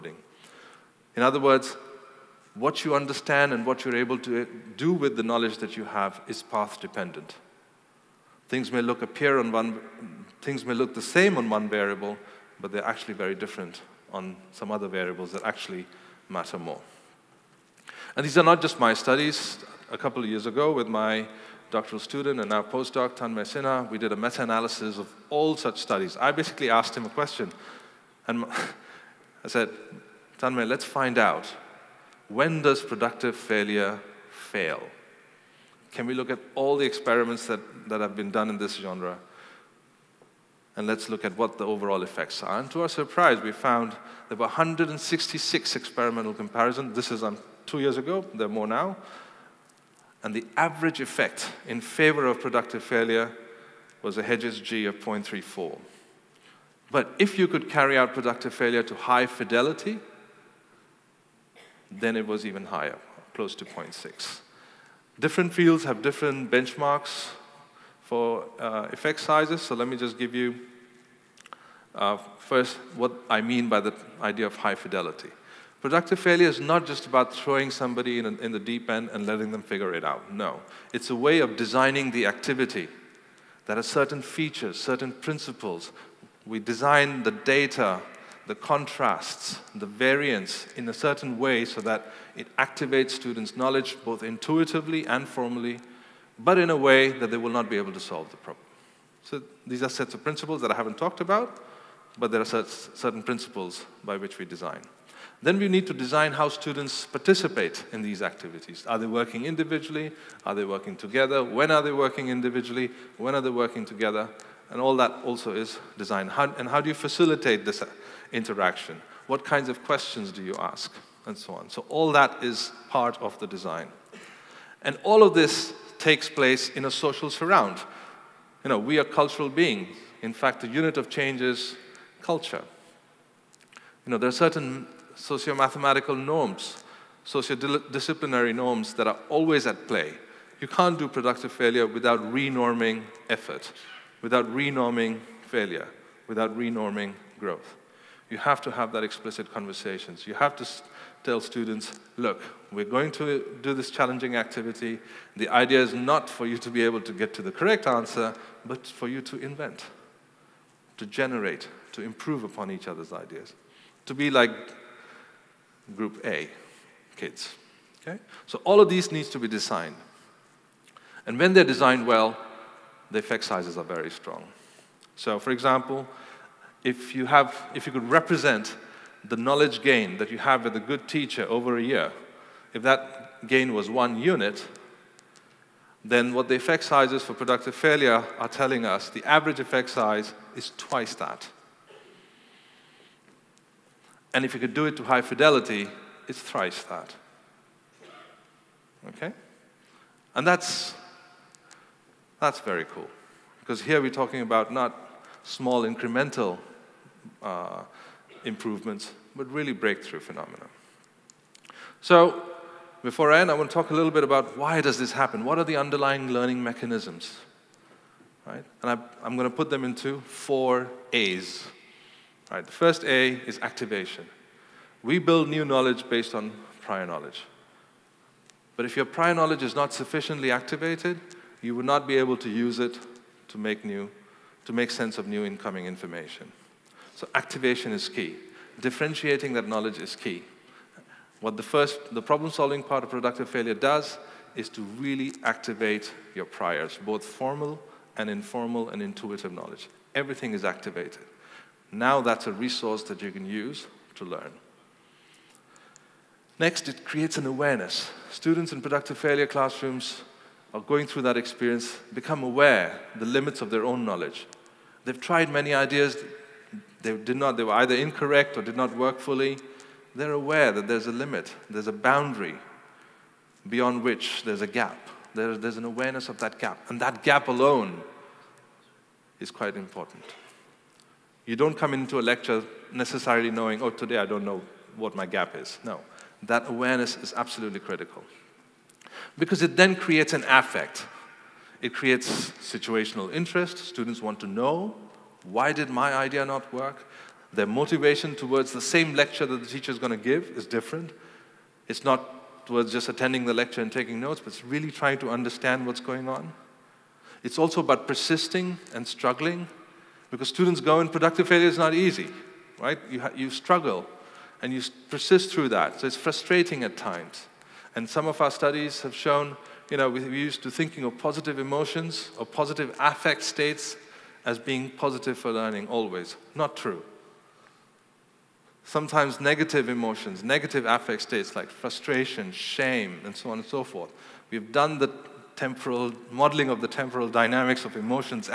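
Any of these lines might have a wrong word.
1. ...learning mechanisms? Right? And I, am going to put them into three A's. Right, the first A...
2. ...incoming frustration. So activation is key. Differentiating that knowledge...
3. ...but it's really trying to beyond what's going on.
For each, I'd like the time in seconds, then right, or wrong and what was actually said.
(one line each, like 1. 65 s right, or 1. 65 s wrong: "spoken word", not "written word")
1. 216 s wrong: "four", not "three"
2. 235 s wrong: "information", not "frustration"
3. 304 s wrong: "understand", not "beyond".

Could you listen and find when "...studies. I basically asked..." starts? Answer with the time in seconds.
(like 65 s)
25 s.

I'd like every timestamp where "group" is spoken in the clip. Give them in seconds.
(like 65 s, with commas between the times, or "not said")
165 s.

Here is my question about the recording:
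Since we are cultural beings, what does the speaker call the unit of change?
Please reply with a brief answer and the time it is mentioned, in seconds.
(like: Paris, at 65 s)
culture, at 132 s.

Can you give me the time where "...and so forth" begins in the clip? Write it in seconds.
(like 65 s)
333 s.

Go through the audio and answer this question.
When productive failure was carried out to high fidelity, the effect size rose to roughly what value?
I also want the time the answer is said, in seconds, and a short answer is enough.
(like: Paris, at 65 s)
0.6, at 63 s.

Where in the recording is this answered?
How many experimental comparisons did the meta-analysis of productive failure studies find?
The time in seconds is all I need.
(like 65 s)
44 s.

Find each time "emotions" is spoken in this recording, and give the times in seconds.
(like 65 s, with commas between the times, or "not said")
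321 s, 329 s, 337 s.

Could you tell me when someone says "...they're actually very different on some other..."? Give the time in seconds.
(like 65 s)
12 s.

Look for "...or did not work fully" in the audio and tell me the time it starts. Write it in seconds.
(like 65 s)
268 s.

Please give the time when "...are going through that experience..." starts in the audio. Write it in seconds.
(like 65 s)
260 s.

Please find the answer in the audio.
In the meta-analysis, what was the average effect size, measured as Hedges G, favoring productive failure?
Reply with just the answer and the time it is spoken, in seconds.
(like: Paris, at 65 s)
0.34, at 54 s.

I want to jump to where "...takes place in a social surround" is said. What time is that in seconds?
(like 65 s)
125 s.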